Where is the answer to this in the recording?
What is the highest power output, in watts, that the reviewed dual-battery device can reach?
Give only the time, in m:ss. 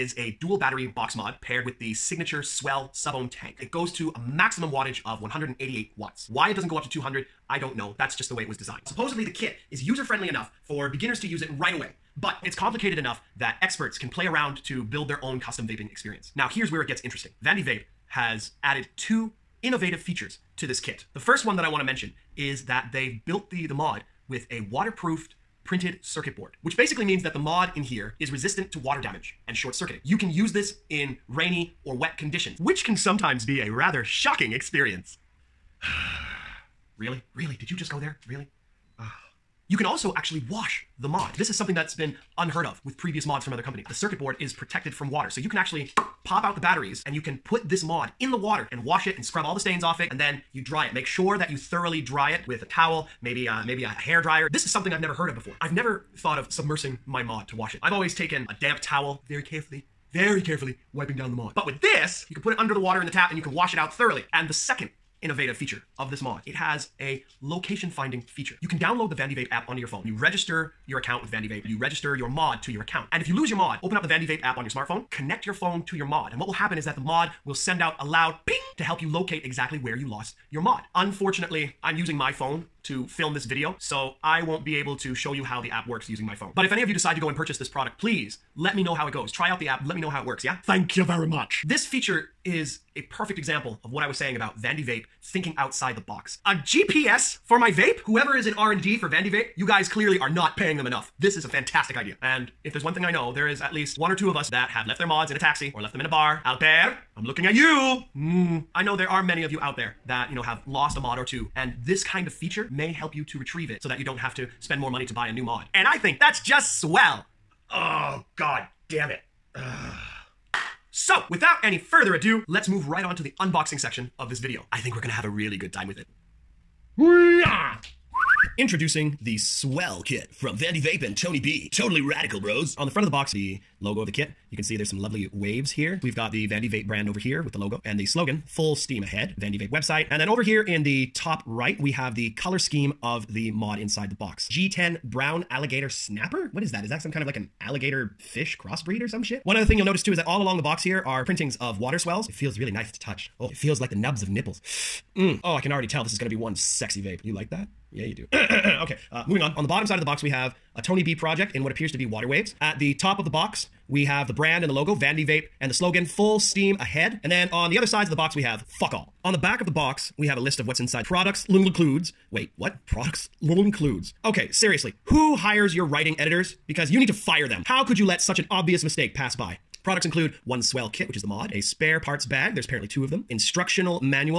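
0:05.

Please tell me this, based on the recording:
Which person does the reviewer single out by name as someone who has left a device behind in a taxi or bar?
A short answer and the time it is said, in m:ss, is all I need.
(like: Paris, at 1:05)
Albert, at 1:46.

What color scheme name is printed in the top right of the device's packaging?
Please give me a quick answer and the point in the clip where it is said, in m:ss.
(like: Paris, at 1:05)
G10 Brown Alligator Snapper, at 2:24.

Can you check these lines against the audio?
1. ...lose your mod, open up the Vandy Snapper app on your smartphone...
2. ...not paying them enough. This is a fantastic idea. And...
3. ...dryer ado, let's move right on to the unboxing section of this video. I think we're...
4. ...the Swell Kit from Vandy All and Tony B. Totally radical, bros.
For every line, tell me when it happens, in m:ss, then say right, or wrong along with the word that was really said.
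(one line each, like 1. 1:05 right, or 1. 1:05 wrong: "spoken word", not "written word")
1. 1:13 wrong: "Vape", not "Snapper"
2. 1:40 right
3. 2:01 wrong: "further", not "dryer"
4. 2:09 wrong: "Vape", not "All".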